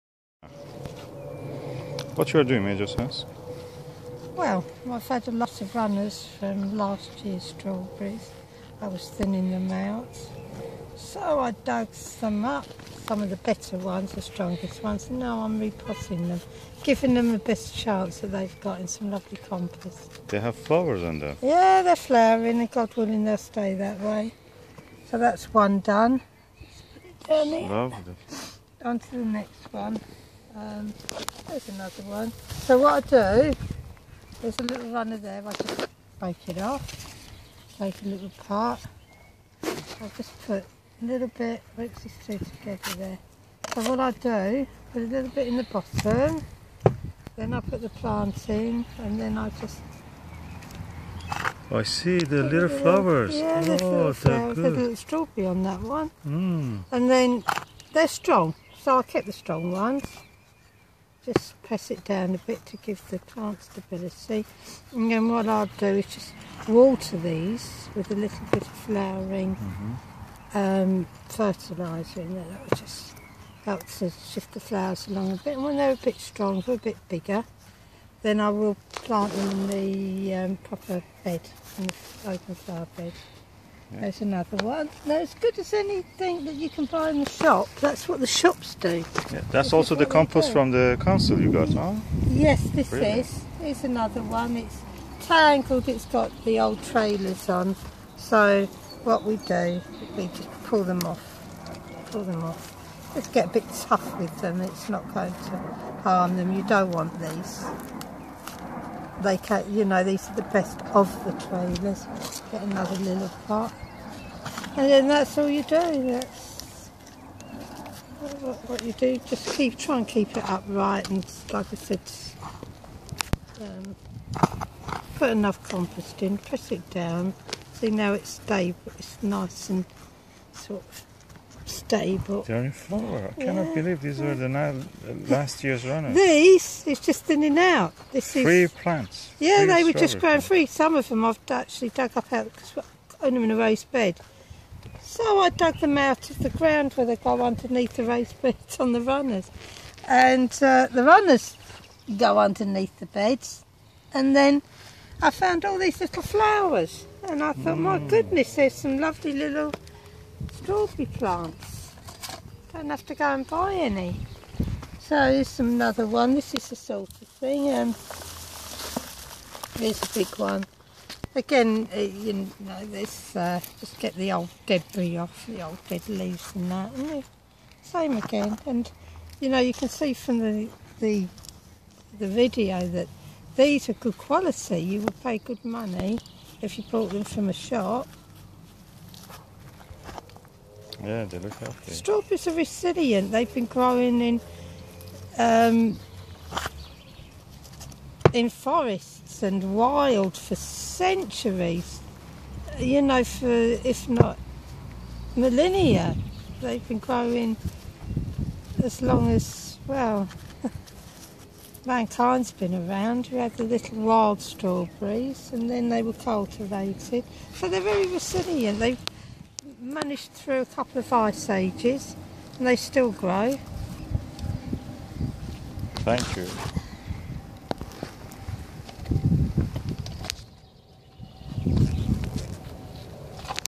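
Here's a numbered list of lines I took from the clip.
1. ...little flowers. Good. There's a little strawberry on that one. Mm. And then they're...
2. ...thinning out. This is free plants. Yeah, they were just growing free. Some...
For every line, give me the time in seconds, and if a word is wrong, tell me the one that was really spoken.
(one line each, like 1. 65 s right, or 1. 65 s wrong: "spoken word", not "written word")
1. 53 s right
2. 137 s right.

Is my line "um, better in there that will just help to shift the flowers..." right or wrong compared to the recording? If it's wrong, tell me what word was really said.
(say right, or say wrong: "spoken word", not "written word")
wrong: "fertiliser", not "better".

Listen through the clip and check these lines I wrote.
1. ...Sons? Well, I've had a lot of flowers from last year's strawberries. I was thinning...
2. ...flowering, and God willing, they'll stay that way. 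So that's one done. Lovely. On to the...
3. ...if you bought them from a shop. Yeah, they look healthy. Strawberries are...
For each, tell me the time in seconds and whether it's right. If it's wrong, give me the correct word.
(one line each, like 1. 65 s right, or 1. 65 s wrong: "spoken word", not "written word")
1. 2 s wrong: "runners", not "flowers"
2. 21 s right
3. 186 s right.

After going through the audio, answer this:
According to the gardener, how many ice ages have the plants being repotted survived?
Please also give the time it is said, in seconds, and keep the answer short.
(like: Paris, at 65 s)
A couple, at 220 s.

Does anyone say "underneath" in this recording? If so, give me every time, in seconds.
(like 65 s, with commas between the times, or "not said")
147 s, 152 s.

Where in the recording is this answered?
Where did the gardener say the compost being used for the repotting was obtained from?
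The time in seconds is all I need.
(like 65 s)
91 s.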